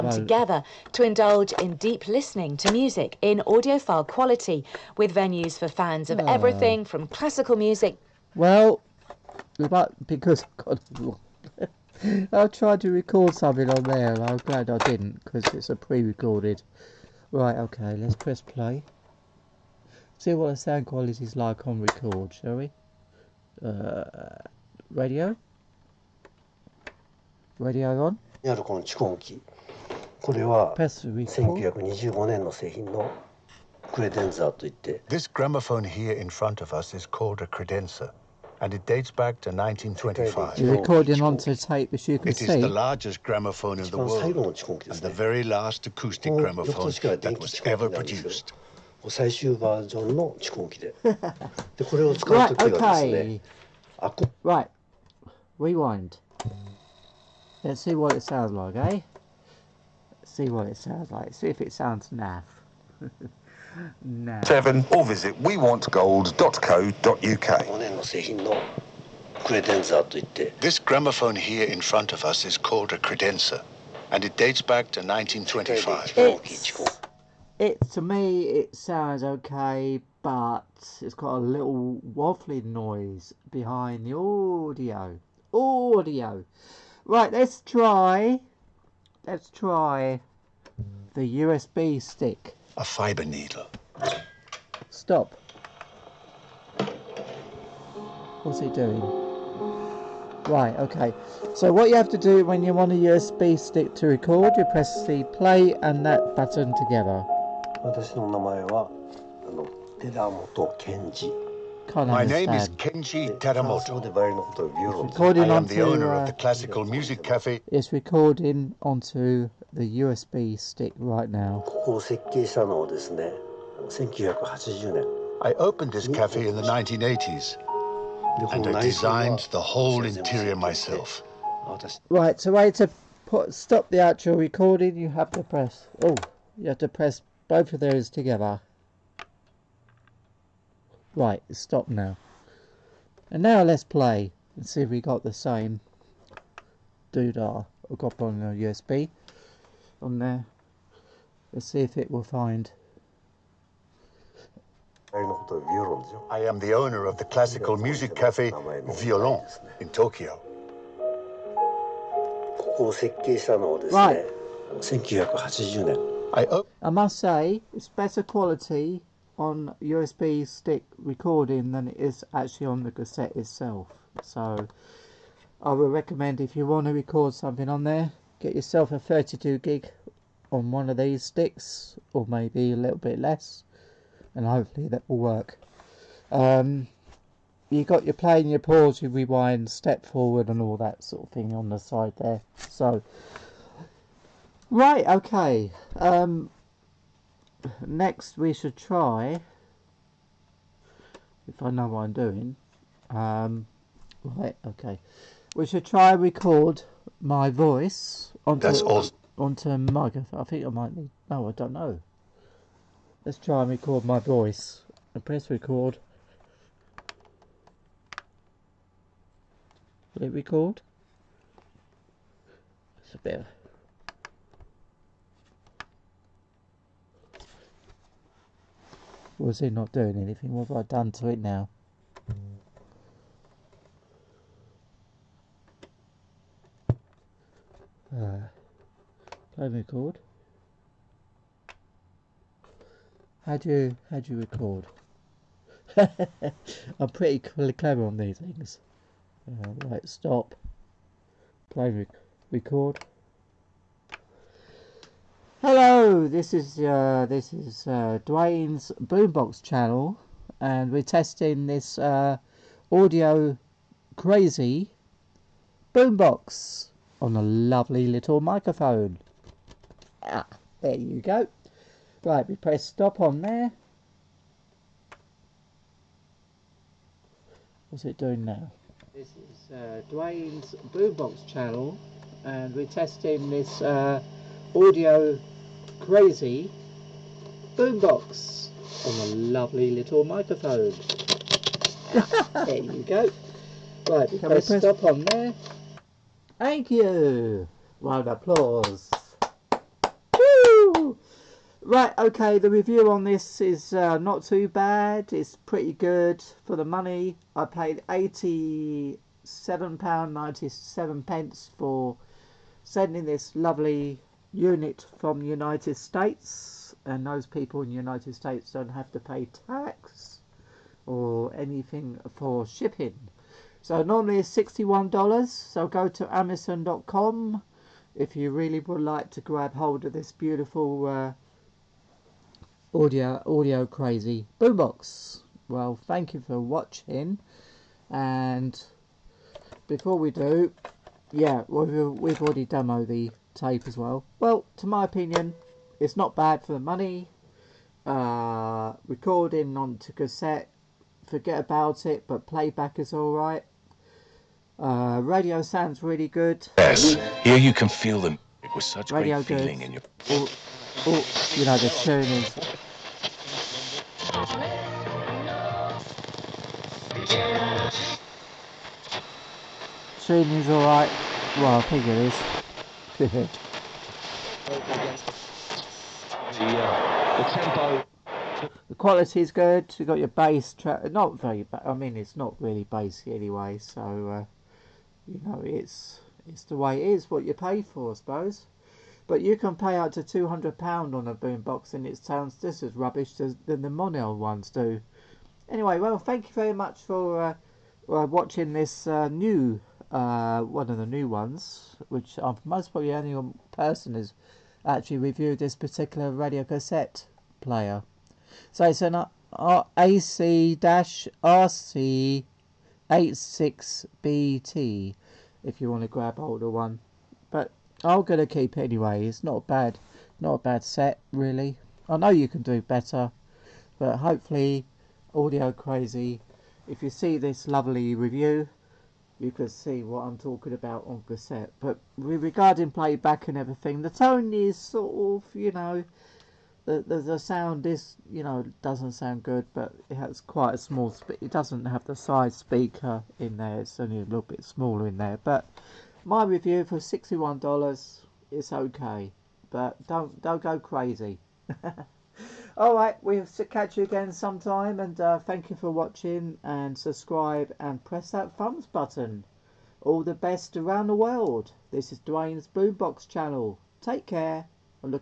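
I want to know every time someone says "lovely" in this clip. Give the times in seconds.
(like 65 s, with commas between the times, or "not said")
267 s, 289 s, 313 s, 427 s.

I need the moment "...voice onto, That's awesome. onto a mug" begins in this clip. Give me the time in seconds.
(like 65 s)
207 s.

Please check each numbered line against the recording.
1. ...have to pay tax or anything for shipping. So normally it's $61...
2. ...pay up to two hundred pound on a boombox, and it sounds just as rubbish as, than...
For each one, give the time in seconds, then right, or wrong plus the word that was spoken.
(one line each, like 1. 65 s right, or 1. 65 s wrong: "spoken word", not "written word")
1. 318 s right
2. 389 s right.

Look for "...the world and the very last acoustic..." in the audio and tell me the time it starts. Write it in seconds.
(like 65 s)
43 s.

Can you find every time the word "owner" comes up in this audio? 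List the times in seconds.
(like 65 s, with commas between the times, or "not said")
115 s, 156 s.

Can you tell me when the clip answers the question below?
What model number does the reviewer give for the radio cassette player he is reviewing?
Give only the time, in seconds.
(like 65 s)
409 s.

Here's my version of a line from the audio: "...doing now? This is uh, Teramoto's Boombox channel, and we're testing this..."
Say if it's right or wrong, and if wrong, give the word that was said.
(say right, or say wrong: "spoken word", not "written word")
wrong: "Duane", not "Teramoto".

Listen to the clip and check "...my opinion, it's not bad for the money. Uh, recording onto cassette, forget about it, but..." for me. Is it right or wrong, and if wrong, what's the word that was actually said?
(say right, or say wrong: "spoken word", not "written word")
right.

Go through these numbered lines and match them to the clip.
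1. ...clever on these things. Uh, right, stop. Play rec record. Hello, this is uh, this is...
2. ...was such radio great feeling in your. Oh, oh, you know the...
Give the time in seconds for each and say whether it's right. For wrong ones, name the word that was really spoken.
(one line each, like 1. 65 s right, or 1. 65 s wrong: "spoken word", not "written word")
1. 247 s right
2. 358 s right.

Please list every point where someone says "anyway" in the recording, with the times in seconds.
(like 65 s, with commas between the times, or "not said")
383 s, 395 s, 418 s.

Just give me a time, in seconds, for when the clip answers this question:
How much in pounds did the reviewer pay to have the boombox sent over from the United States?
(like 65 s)
308 s.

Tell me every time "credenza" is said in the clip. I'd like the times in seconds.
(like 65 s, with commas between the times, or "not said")
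37 s, 72 s.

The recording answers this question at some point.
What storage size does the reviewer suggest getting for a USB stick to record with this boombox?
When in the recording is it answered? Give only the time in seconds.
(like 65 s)
178 s.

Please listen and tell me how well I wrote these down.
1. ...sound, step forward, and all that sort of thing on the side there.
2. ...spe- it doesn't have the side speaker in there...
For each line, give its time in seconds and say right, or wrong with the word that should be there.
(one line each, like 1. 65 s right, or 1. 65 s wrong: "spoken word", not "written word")
1. 189 s wrong: "rewind", not "sound"
2. 441 s right.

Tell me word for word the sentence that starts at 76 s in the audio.
It's it to me it sounds okay, but it's got a little waffling noise behind the audio.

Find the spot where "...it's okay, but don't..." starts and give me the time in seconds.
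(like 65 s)
448 s.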